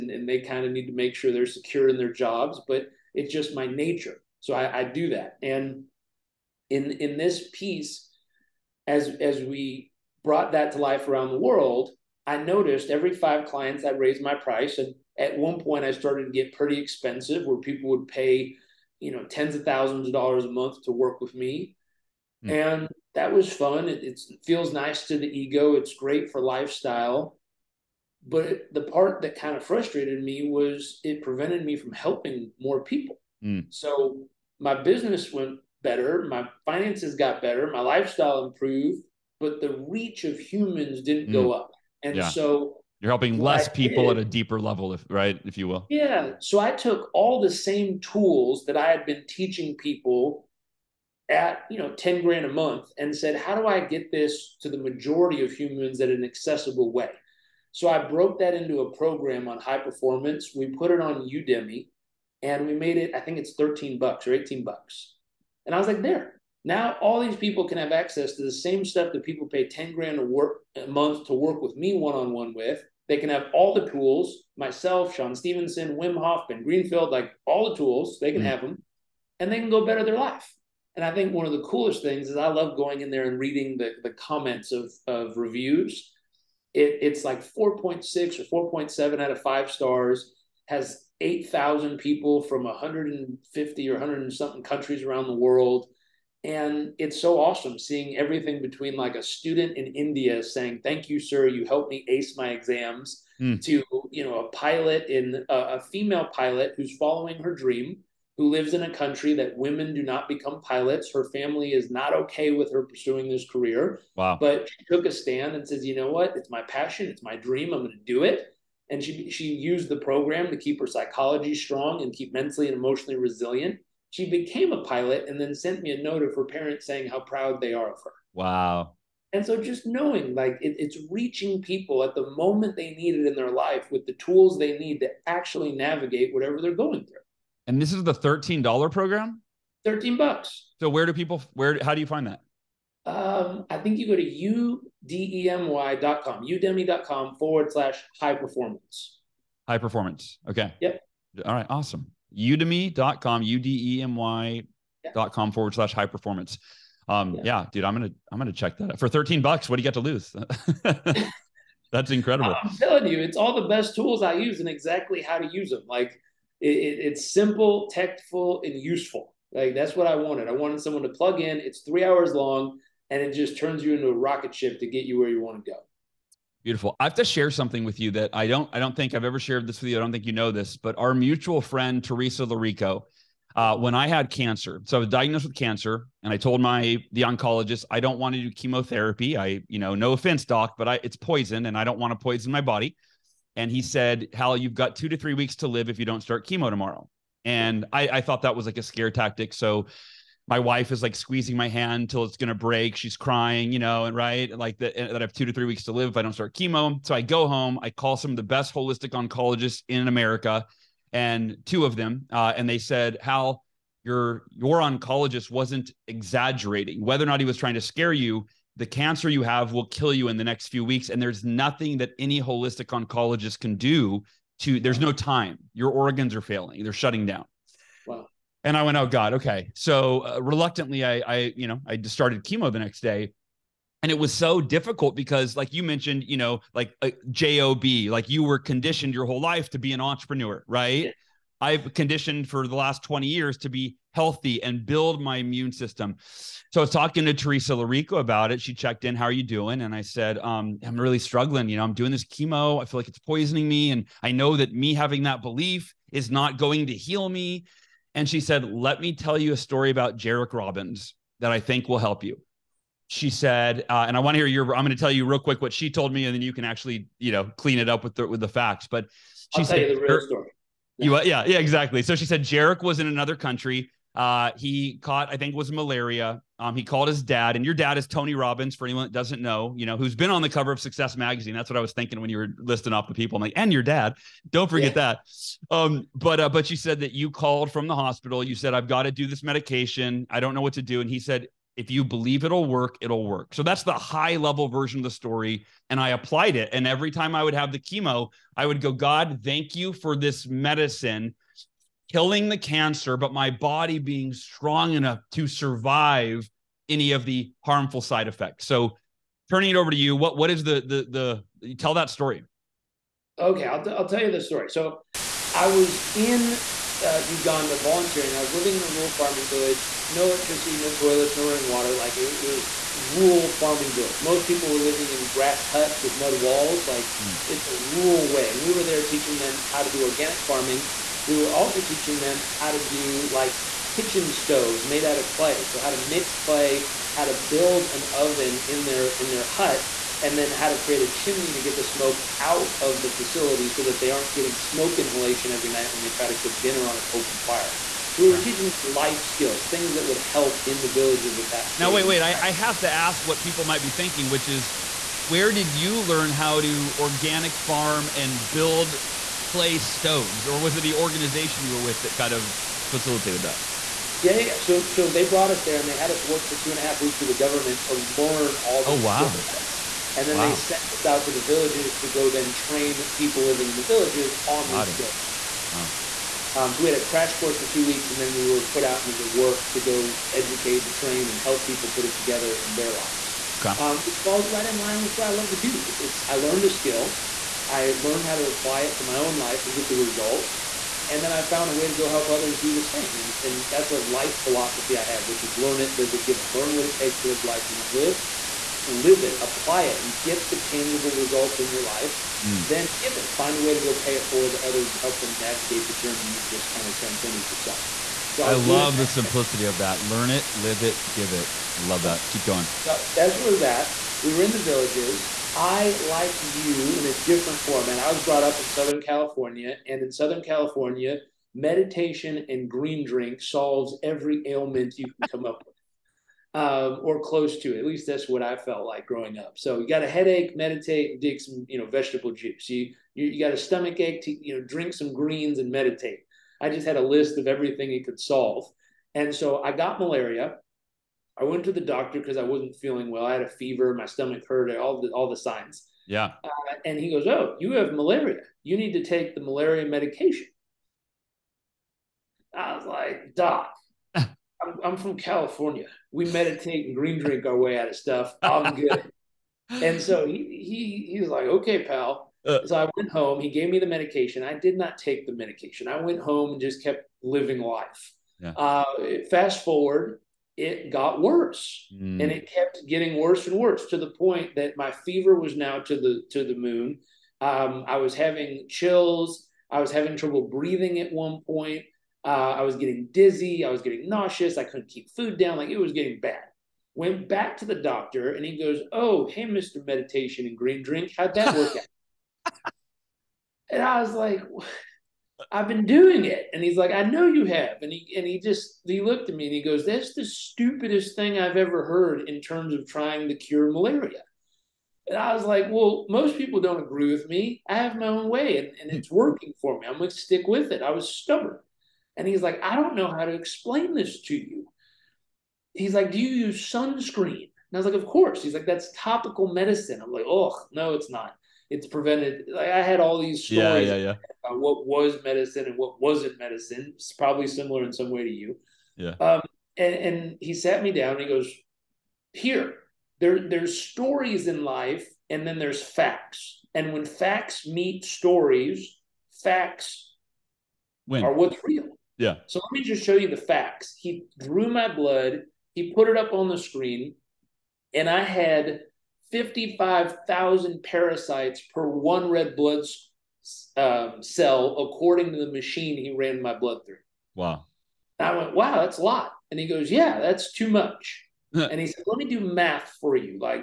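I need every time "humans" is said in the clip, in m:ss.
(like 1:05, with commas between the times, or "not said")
0:40, 0:55.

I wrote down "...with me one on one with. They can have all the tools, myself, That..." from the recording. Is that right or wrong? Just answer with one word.
wrong.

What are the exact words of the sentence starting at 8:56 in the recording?
And when facts meet stories, facts are what's real.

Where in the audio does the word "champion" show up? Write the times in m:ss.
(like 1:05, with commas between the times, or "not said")
not said.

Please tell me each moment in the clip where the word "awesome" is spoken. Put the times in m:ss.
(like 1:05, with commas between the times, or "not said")
1:37, 2:31.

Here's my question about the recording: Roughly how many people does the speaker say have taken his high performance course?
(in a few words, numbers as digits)
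8,000.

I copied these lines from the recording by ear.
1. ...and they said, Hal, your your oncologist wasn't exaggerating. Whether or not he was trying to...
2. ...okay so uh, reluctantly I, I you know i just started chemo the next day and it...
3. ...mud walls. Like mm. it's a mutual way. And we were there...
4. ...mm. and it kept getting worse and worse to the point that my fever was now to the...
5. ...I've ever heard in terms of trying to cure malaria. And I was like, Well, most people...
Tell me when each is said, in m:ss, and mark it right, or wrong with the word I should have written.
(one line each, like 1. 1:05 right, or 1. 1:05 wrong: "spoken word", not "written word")
1. 3:32 right
2. 3:49 right
3. 5:26 wrong: "rural", not "mutual"
4. 7:51 right
5. 8:21 right.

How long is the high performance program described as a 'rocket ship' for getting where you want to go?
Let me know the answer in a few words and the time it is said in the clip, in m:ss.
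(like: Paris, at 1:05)
3 hours, at 2:51.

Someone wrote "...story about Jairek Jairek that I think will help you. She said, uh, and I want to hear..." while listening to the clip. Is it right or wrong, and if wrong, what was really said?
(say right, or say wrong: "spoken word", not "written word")
wrong: "Robbins", not "Jairek".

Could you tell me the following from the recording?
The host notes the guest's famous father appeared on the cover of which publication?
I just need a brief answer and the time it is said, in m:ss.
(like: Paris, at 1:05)
Success Magazine, at 4:40.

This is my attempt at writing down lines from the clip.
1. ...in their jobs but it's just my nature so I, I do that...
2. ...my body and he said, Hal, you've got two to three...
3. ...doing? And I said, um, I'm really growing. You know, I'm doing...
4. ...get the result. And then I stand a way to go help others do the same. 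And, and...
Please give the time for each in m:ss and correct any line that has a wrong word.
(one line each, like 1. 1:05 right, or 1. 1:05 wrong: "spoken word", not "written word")
1. 0:01 right
2. 3:12 right
3. 4:09 wrong: "struggling", not "growing"
4. 6:29 wrong: "found", not "stand".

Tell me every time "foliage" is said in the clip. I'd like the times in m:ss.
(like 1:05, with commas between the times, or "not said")
not said.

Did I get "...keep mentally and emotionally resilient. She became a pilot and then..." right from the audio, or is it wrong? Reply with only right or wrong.
right.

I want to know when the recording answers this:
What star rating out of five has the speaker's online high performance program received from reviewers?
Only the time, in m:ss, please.
1:27.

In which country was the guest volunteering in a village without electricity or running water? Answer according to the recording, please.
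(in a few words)
Uganda.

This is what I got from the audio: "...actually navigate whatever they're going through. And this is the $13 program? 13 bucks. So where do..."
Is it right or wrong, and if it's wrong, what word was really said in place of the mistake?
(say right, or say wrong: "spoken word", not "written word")
right.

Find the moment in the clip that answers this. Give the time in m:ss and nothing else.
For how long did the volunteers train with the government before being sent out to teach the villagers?
6:06.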